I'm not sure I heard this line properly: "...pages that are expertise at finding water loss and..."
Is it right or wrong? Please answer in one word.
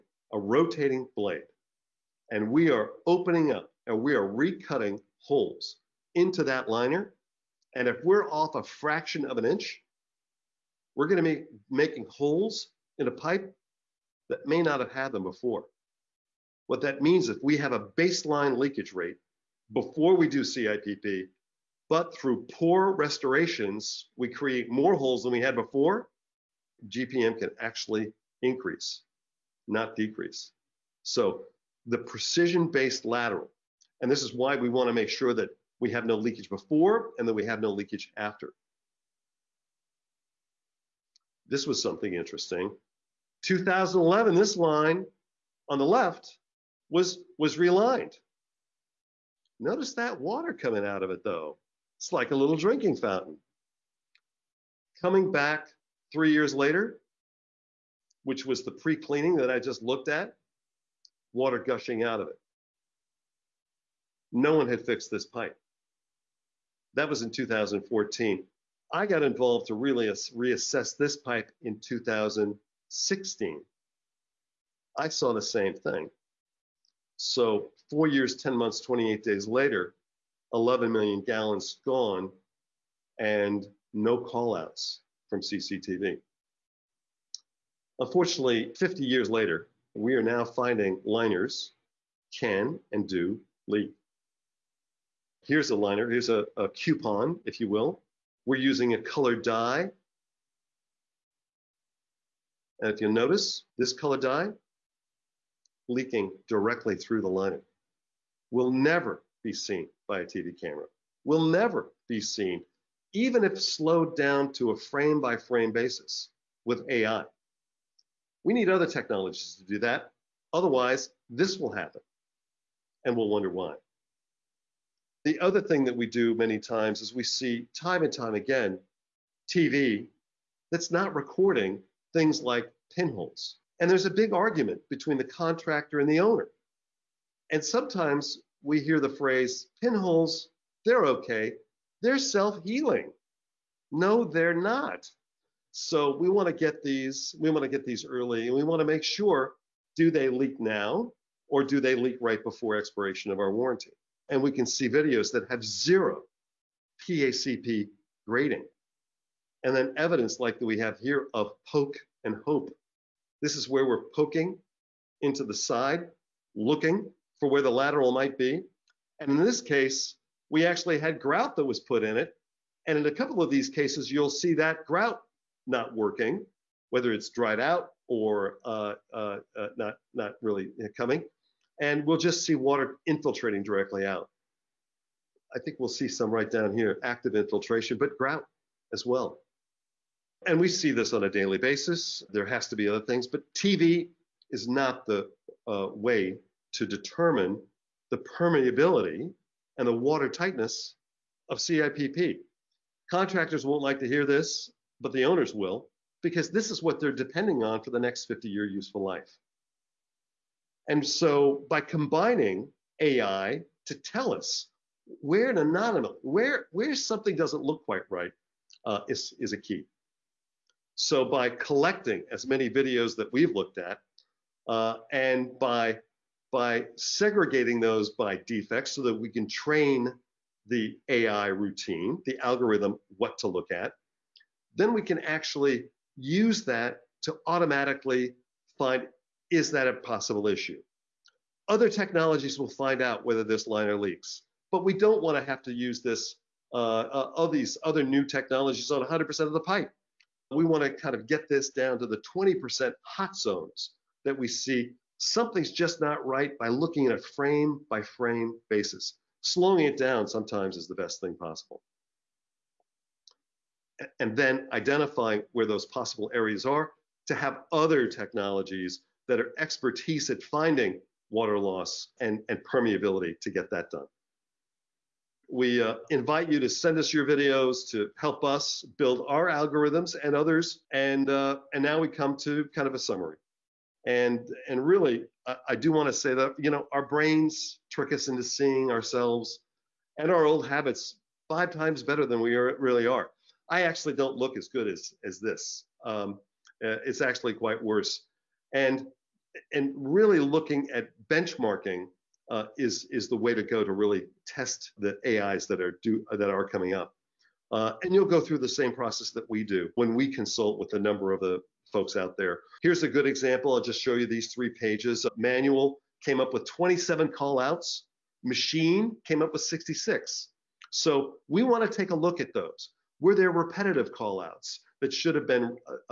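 wrong.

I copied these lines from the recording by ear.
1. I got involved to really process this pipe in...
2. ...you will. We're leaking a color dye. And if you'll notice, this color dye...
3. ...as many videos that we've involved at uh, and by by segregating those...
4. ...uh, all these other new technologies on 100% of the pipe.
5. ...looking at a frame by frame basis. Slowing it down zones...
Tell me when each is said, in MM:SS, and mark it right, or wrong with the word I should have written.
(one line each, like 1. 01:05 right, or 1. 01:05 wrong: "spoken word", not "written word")
1. 01:08 wrong: "reassess", not "process"
2. 01:37 wrong: "using", not "leaking"
3. 03:42 wrong: "looked", not "involved"
4. 04:06 right
5. 04:16 wrong: "sometimes", not "zones".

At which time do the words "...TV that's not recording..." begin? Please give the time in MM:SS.
02:09.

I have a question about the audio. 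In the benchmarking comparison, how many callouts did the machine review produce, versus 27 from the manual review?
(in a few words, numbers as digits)
66.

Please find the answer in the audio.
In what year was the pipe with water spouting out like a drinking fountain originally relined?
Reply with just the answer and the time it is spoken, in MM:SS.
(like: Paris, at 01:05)
2011, at 00:43.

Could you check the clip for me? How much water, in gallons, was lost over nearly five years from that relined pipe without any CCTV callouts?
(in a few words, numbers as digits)
11 million gallons.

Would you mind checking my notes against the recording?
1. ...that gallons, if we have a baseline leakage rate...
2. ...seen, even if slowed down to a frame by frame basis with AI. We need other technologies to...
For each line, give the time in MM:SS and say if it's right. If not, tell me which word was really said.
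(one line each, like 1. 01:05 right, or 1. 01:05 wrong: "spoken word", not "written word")
1. 00:16 wrong: "means", not "gallons"
2. 01:52 right.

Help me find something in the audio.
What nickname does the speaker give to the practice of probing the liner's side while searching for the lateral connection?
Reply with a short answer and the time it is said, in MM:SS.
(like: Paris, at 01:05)
poke and hope, at 02:41.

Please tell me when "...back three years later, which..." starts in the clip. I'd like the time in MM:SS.
00:55.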